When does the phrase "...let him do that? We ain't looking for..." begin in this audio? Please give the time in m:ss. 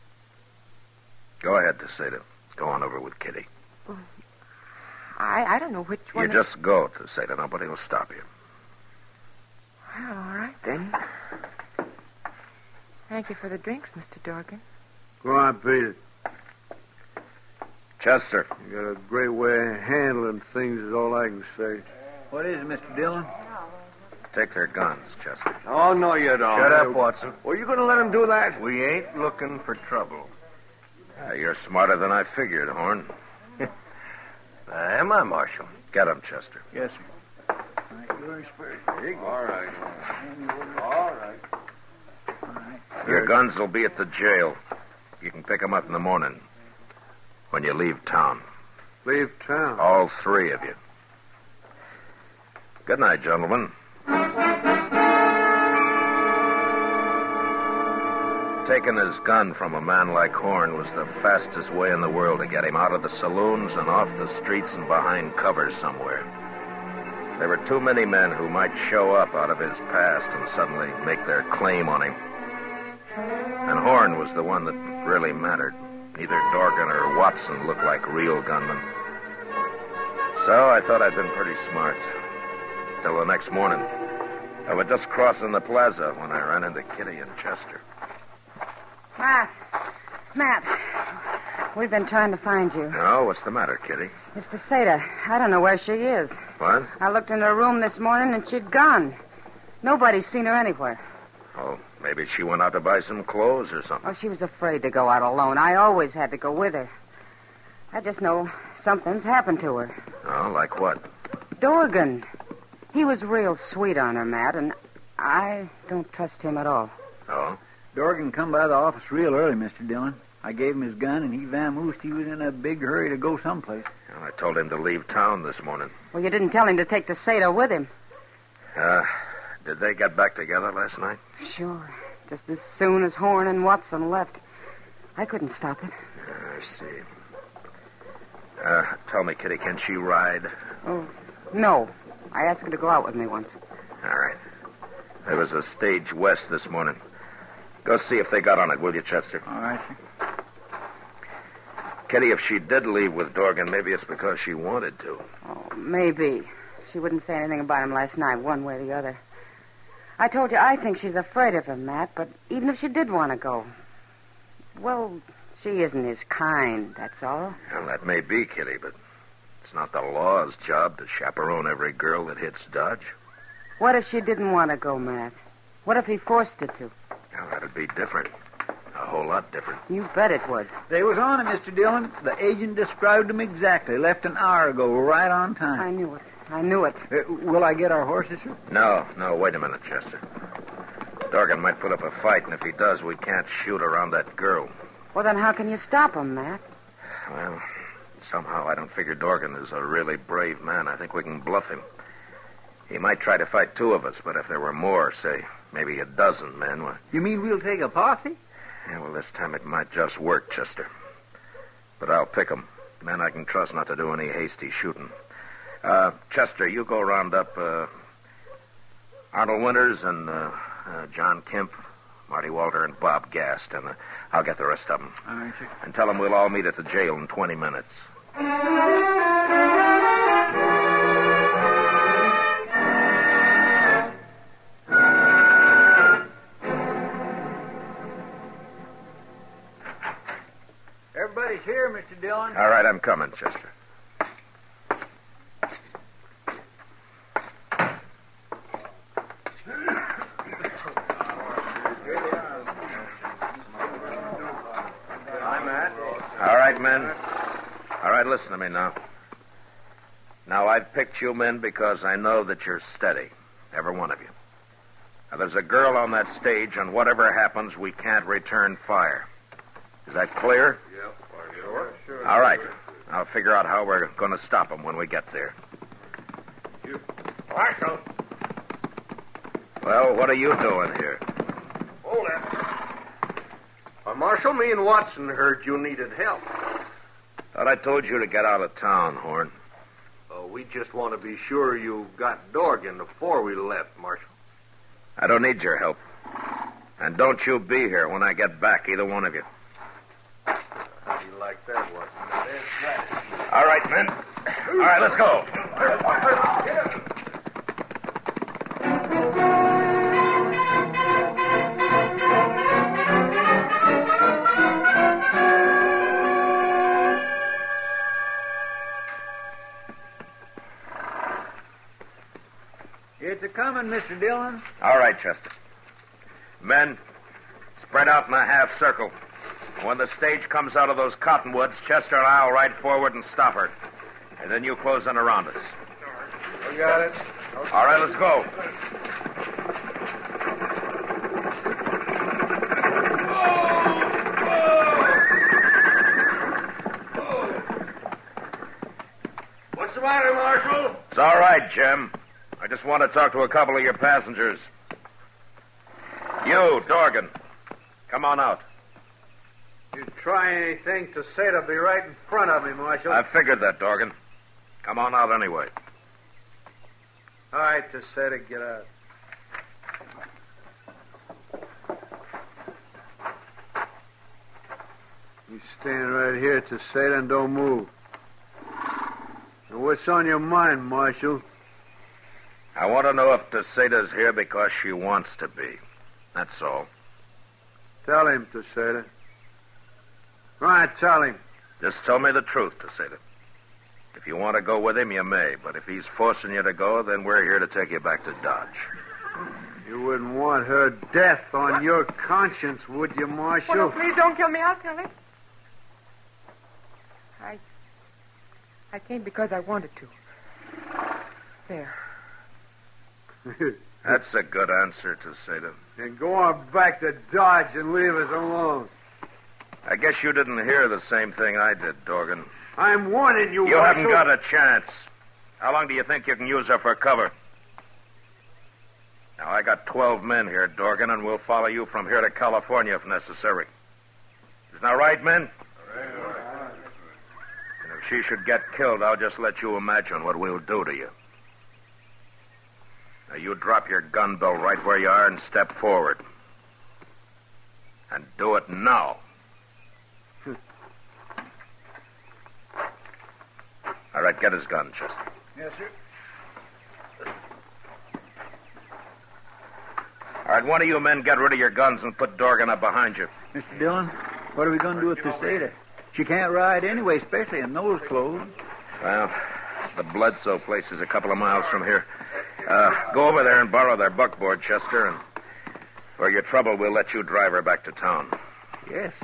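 0:27.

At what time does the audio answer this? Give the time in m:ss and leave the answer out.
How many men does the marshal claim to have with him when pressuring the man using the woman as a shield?
7:09.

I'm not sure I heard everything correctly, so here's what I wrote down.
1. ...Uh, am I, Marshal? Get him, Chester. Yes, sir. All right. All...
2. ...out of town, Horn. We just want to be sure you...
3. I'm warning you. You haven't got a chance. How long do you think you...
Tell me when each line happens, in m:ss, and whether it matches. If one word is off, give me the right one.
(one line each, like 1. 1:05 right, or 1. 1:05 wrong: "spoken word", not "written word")
1. 0:34 right
2. 4:48 right
3. 7:02 right.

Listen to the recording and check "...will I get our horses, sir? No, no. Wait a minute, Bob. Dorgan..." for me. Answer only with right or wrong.
wrong.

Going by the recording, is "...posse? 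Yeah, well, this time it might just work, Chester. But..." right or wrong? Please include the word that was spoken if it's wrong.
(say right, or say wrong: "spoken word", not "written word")
right.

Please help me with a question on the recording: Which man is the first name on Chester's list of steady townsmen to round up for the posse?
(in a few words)
Arnold Winters.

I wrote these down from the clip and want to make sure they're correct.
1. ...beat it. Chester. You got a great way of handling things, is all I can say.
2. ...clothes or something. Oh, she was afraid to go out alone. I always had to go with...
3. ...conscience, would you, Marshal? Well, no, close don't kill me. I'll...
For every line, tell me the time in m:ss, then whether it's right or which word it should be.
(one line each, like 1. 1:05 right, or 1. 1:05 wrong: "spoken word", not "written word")
1. 0:15 right
2. 1:43 right
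3. 6:42 wrong: "please", not "close".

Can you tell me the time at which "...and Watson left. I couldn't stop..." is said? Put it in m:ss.
2:13.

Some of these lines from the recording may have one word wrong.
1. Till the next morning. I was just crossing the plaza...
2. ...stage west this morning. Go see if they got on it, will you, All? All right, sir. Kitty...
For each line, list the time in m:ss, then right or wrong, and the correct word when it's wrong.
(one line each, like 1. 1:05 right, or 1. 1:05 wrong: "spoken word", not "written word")
1. 1:23 right
2. 2:25 wrong: "Chester", not "All".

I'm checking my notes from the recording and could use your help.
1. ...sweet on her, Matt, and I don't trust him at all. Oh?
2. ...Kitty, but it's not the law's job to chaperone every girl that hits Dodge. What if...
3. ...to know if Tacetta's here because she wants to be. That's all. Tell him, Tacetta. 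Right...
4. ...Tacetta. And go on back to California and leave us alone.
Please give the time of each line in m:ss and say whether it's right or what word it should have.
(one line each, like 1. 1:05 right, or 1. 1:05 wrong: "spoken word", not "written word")
1. 1:53 right
2. 2:48 right
3. 6:23 right
4. 6:55 wrong: "Dodge", not "California".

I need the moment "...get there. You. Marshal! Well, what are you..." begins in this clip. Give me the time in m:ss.
4:35.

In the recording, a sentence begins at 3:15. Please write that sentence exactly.
Well, then how can you stop him, Matt?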